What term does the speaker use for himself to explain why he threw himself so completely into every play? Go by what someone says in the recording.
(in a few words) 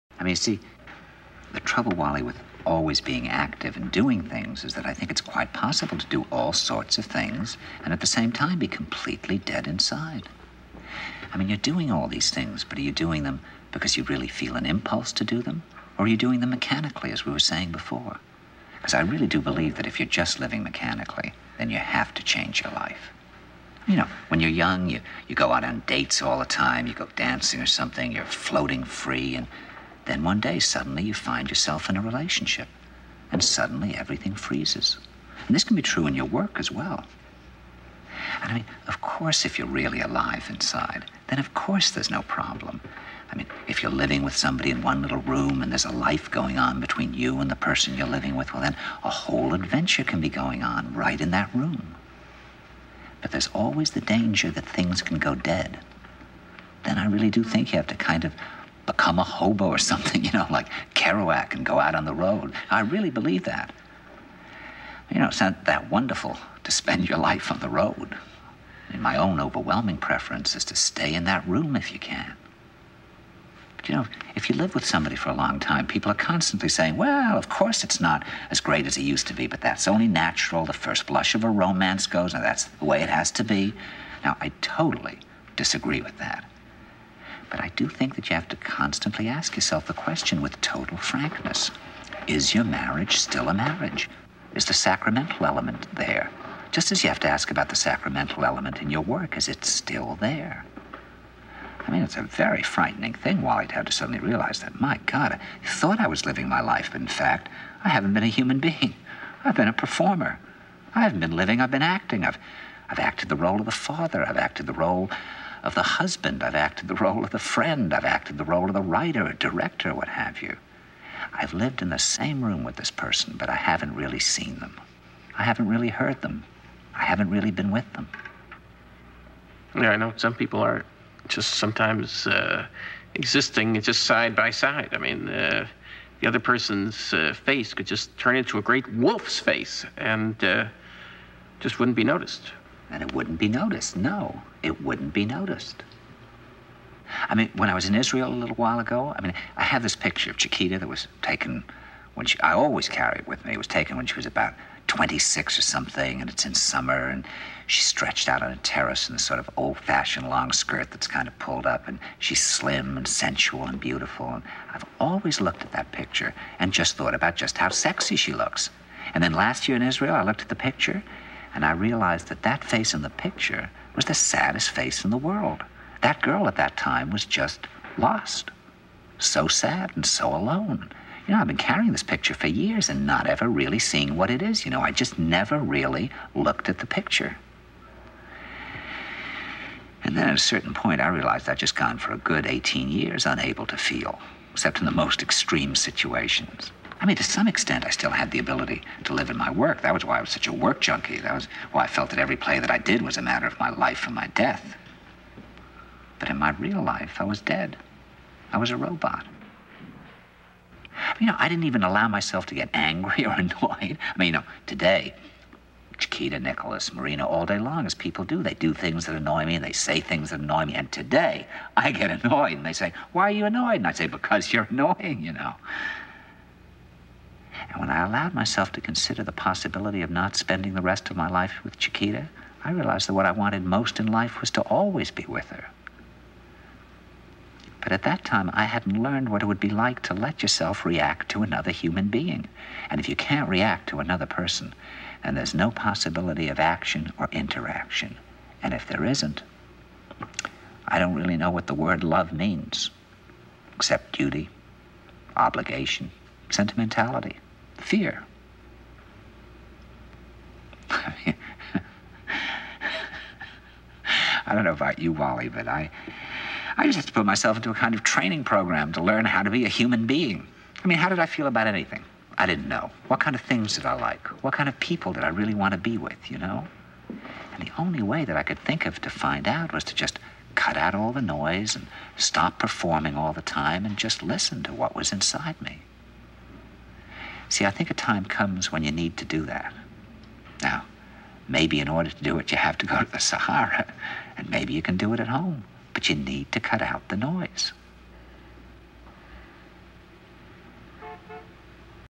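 work junkie.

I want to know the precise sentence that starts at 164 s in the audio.
And I've always looked at that picture and just thought about just how sexy she looks.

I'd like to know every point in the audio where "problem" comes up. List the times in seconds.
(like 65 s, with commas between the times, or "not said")
42 s.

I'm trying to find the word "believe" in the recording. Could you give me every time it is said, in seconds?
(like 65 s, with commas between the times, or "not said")
19 s, 63 s.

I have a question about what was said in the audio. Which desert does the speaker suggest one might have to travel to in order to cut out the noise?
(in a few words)
Sahara.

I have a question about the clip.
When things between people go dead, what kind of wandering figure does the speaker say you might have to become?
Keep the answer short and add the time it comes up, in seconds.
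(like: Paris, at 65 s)
hobo, at 59 s.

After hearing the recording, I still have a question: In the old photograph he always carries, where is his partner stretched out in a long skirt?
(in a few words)
on a terrace.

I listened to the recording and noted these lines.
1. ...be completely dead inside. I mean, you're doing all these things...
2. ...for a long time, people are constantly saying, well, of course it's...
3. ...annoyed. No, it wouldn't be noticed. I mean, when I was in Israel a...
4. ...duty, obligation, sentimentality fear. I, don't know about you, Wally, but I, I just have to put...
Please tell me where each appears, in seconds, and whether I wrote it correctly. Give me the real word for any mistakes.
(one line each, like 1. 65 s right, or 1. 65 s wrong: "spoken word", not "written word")
1. 8 s right
2. 75 s right
3. 143 s wrong: "noticed", not "annoyed"
4. 254 s right.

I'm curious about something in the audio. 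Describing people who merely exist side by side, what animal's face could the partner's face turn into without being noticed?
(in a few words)
wolf.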